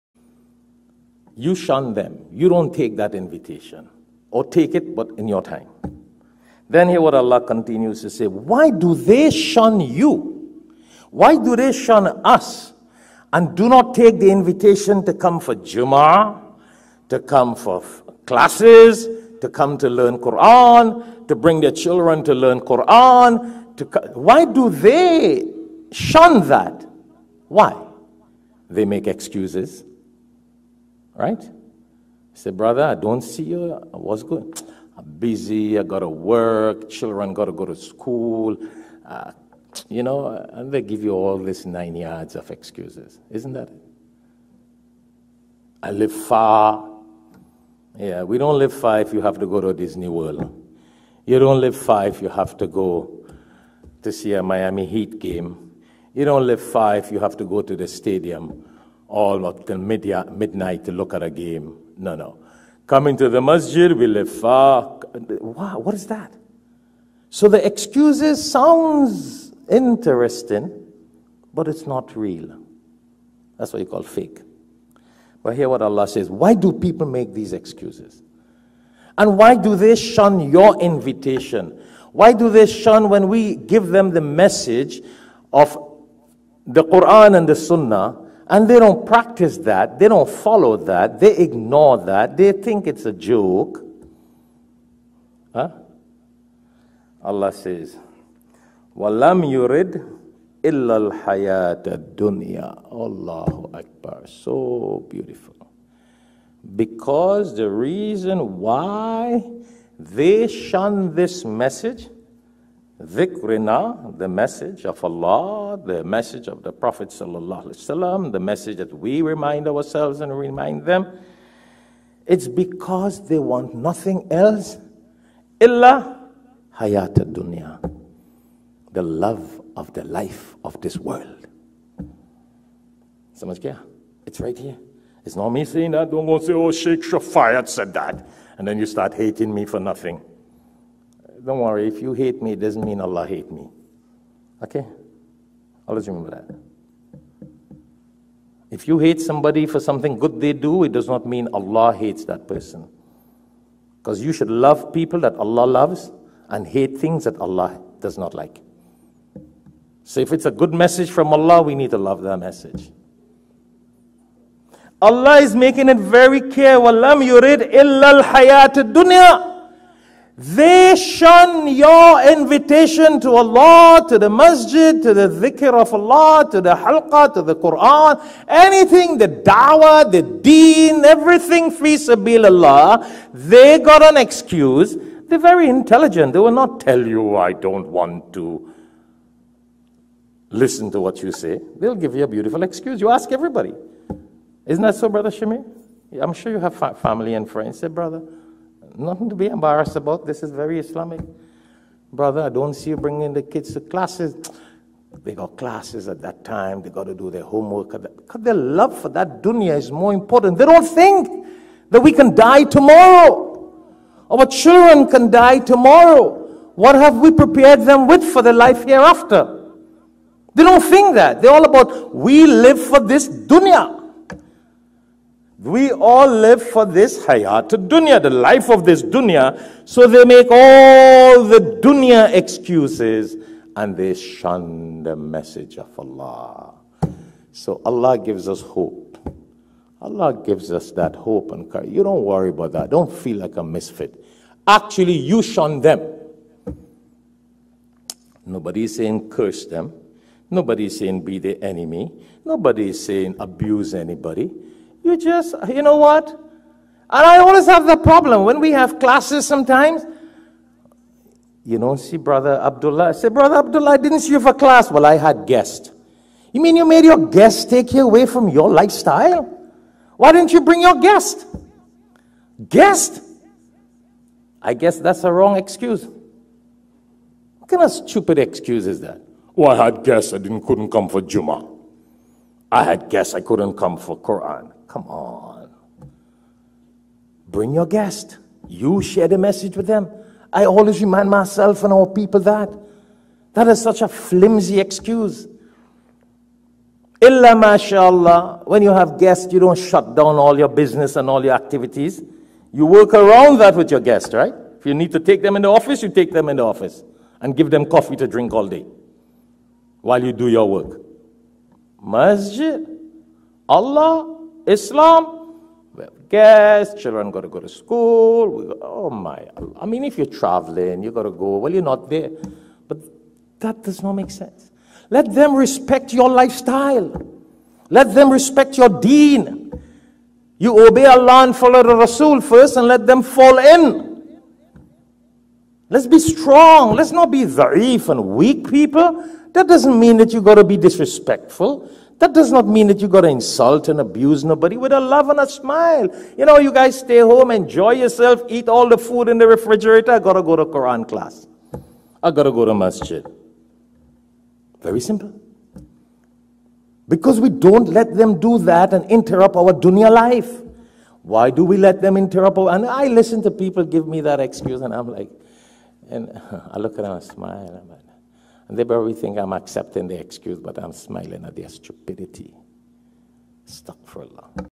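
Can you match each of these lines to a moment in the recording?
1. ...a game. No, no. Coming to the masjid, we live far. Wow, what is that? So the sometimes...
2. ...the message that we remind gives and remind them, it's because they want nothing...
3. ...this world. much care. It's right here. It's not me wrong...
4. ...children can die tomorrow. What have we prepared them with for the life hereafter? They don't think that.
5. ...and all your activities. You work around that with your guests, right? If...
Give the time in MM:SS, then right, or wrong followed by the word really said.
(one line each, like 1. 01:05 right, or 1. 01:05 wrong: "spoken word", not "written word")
1. 01:01 wrong: "excuses", not "sometimes"
2. 01:58 wrong: "ourselves", not "gives"
3. 02:10 wrong: "saying", not "wrong"
4. 03:34 right
5. 05:01 right.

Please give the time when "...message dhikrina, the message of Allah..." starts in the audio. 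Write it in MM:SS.
01:51.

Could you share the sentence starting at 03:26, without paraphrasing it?
They got to do their homework.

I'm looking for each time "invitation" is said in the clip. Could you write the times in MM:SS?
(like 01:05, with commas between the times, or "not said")
00:03, 00:14, 01:20, 02:52.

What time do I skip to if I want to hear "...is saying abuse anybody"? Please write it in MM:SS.
04:12.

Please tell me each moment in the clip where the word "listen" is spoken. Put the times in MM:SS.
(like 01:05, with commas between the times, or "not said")
03:10, 06:03.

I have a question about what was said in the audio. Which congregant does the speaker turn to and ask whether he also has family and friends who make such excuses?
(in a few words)
Brother Shami.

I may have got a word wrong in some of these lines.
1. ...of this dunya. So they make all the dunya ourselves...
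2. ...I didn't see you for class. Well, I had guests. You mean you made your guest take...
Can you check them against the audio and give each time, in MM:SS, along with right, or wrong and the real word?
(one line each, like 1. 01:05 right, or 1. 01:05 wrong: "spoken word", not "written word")
1. 03:48 wrong: "excuses", not "ourselves"
2. 04:23 right.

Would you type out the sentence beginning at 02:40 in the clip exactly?
So if it's a good message from Allah, we need to love that message.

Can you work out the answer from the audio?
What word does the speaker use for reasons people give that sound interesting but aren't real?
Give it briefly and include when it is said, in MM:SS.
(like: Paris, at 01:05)
fake, at 01:14.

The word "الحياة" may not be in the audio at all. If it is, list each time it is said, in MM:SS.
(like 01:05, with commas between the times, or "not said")
01:41, 02:48.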